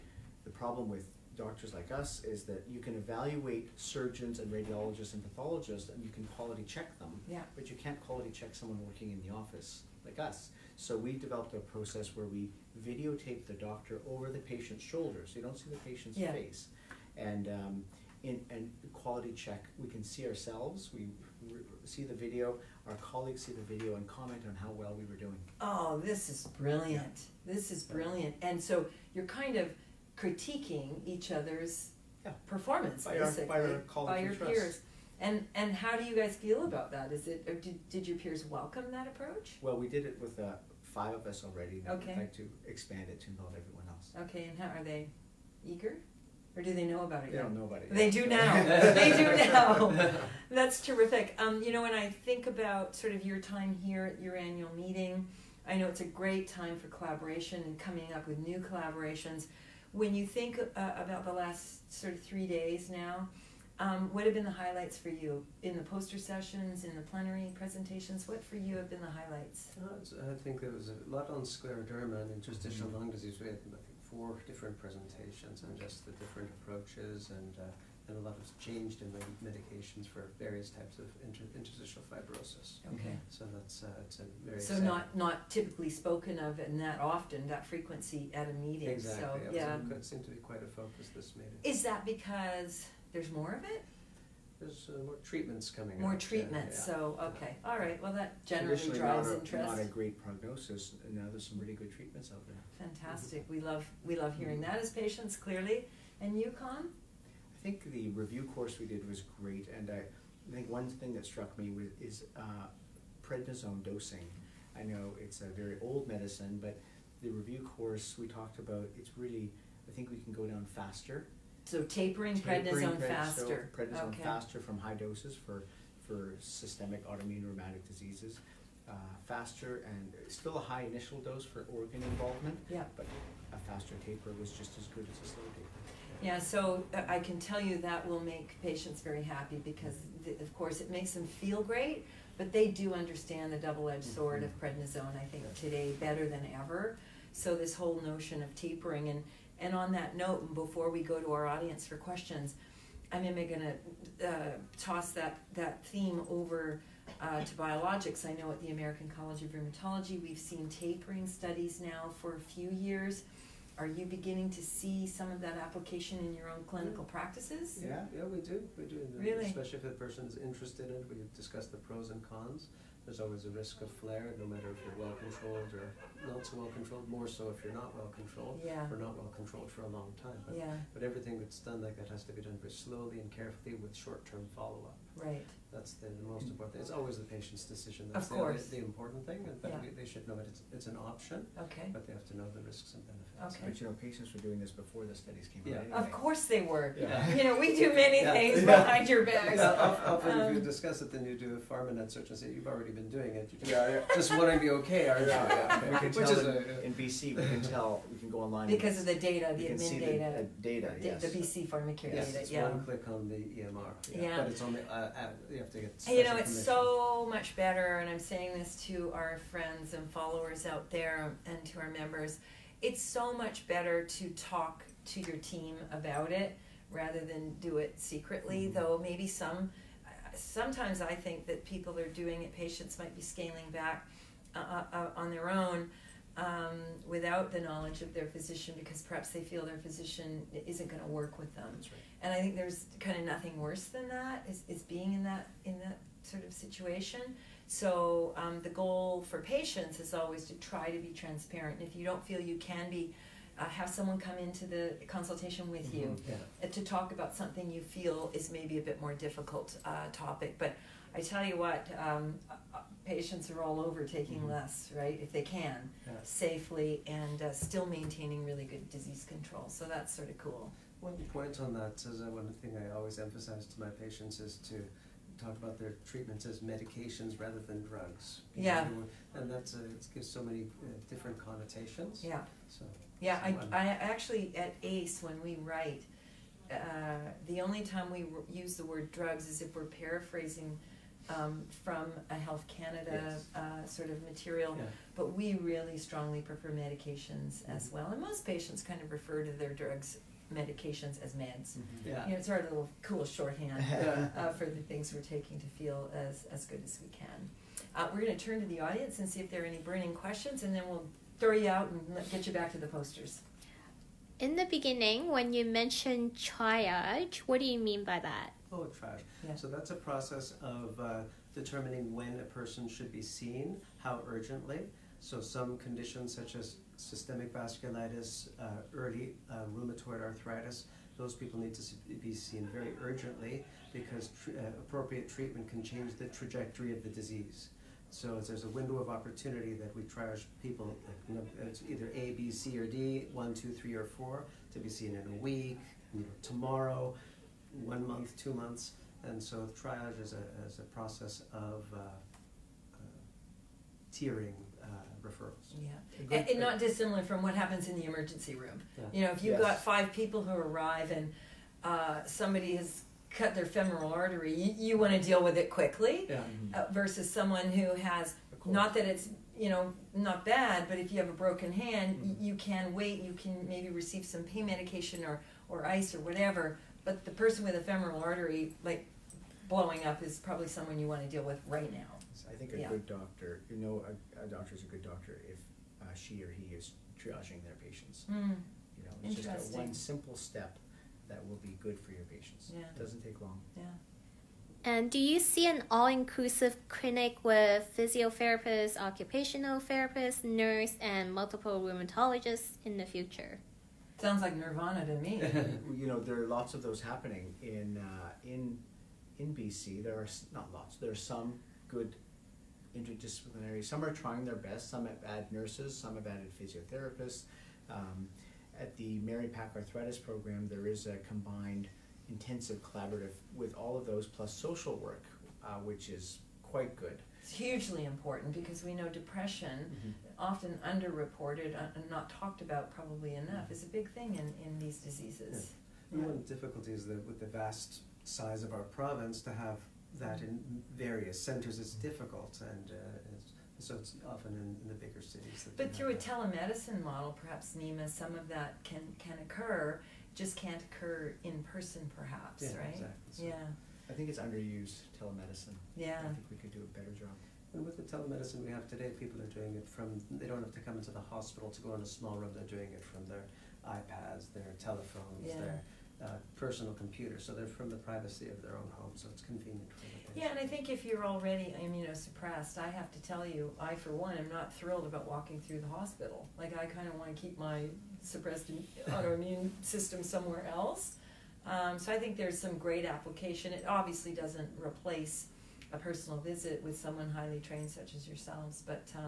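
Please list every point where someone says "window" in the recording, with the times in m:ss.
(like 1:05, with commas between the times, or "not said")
5:38.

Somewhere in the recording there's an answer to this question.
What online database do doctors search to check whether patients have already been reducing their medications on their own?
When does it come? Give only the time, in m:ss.
3:21.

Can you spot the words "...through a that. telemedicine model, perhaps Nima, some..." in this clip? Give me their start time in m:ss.
7:25.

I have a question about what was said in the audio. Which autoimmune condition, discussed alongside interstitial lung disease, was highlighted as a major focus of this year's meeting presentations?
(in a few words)
scleroderma.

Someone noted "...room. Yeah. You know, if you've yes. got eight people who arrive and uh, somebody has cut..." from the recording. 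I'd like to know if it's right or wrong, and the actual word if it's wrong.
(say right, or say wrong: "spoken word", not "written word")
wrong: "five", not "eight".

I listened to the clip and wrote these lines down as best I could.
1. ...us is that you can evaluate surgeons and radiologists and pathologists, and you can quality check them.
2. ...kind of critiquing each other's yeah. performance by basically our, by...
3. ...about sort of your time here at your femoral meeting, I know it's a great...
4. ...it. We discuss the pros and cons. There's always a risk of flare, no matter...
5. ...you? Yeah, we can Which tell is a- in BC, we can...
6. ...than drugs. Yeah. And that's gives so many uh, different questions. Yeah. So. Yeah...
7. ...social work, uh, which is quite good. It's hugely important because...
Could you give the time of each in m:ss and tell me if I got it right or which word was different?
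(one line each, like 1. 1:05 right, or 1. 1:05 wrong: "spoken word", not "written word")
1. 0:01 right
2. 0:29 right
3. 0:52 wrong: "annual", not "femoral"
4. 2:50 right
5. 3:25 right
6. 4:37 wrong: "connotations", not "questions"
7. 7:04 right.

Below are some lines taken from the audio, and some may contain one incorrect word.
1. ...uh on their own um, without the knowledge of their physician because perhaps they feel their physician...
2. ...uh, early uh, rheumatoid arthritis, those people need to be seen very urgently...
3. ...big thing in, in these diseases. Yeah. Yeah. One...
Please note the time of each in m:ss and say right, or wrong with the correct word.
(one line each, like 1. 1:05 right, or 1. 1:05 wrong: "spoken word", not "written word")
1. 3:54 right
2. 5:28 right
3. 7:13 right.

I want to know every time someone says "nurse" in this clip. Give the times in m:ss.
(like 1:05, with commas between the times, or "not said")
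6:40, 6:55.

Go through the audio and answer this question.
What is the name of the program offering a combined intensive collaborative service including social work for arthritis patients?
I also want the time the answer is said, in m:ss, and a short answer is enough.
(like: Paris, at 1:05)
Mary Pack Arthritis Program, at 6:59.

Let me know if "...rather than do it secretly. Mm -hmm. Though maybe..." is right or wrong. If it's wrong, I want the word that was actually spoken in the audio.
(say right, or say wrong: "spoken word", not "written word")
right.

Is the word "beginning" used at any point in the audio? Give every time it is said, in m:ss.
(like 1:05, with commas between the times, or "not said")
2:44, 5:14.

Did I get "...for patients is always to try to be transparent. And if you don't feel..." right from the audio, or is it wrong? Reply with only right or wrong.
right.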